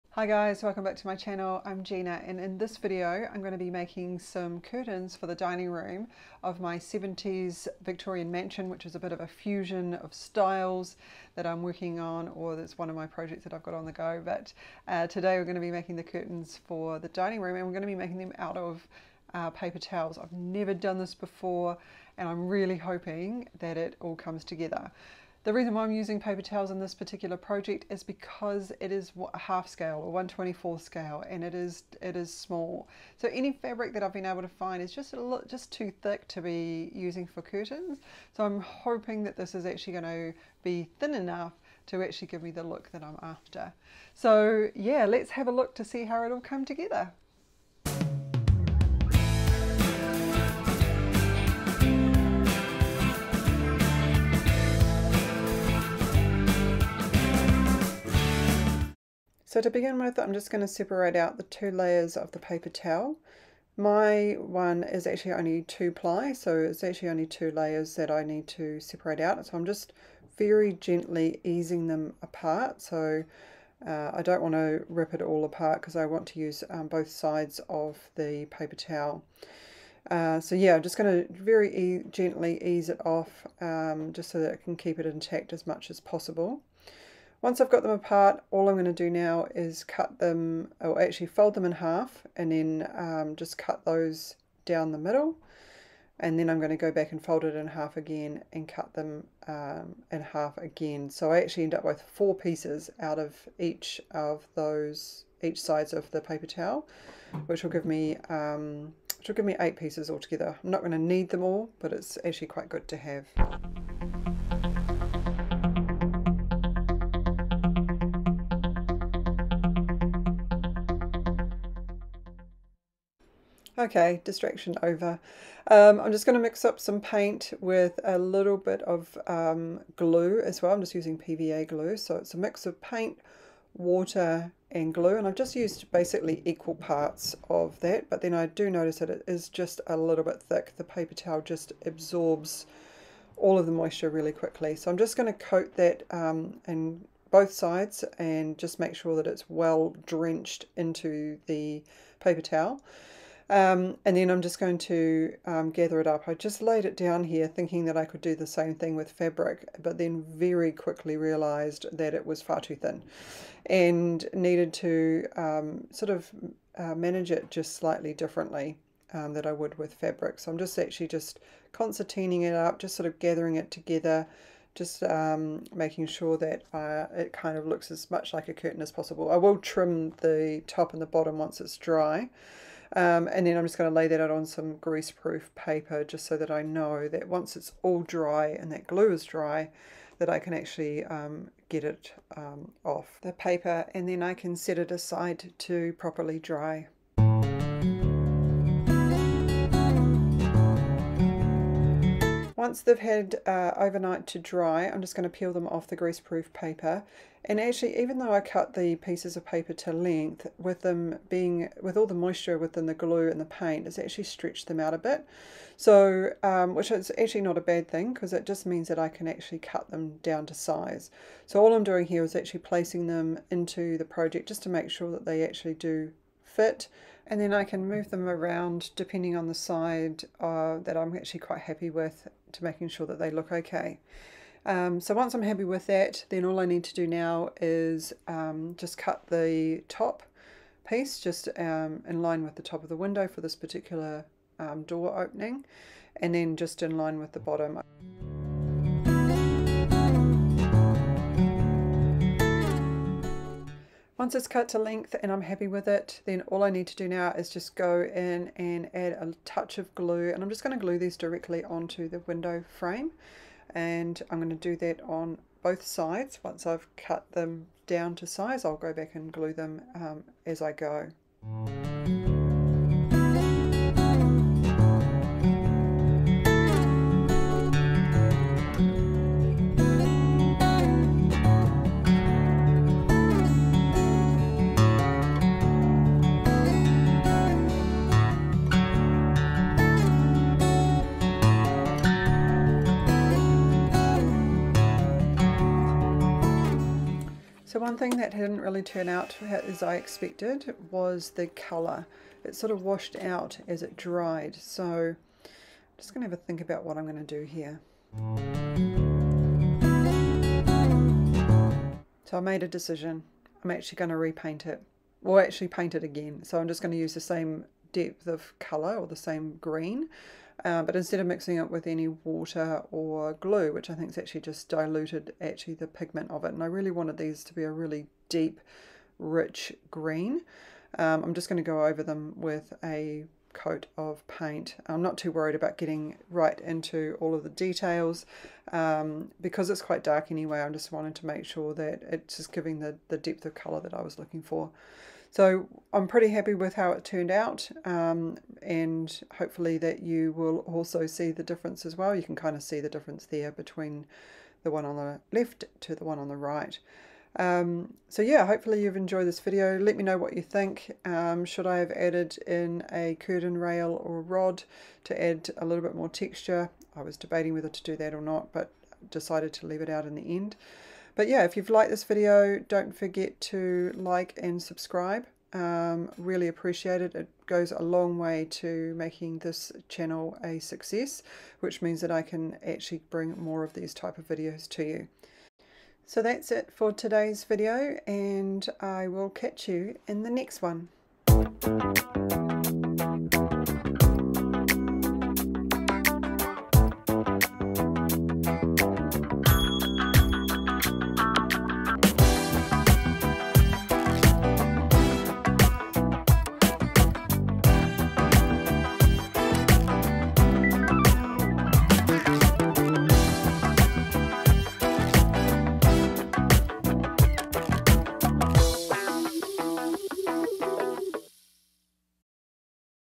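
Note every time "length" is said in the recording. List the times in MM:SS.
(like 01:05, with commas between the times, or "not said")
03:29, 04:14.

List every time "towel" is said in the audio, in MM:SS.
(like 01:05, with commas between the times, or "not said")
00:19, 00:26, 01:02, 01:18, 01:46, 02:21, 02:32.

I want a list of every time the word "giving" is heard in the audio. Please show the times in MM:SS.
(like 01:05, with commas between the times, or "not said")
05:42.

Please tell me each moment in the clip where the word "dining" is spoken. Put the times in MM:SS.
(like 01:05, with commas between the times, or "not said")
00:05, 00:17.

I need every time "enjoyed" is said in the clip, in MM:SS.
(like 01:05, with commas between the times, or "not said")
05:58.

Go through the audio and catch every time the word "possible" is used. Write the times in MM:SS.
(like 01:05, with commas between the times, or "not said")
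01:25, 02:58.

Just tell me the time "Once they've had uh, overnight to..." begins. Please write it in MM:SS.
03:22.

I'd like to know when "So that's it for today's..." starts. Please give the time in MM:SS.
06:26.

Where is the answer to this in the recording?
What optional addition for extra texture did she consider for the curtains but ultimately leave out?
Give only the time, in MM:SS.
06:03.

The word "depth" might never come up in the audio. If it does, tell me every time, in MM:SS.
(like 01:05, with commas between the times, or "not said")
05:17, 05:43.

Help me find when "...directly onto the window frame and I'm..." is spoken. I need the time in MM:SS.
04:21.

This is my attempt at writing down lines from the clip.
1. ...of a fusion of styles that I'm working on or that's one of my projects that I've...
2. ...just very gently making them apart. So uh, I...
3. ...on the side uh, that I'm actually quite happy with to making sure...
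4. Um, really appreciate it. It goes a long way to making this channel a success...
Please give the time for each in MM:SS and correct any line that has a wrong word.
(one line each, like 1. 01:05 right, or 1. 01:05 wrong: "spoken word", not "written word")
1. 00:09 right
2. 01:09 wrong: "easing", not "making"
3. 03:49 right
4. 06:15 right.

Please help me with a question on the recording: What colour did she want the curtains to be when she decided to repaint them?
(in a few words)
deep, rich green.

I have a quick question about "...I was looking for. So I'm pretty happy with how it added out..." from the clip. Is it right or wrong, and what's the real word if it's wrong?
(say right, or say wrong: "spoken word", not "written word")
wrong: "turned", not "added".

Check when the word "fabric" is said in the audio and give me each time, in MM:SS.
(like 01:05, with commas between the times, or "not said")
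00:33, 02:39, 02:49.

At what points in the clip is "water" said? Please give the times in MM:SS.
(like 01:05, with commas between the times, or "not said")
02:13, 05:22.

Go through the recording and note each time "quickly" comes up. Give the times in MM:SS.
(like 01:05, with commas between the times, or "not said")
02:24, 02:40.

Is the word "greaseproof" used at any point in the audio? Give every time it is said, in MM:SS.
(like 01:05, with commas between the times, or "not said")
03:04, 03:25.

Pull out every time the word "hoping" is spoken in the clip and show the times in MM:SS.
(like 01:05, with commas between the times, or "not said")
00:22, 00:38.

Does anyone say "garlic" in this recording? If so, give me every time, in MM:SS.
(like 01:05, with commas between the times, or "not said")
not said.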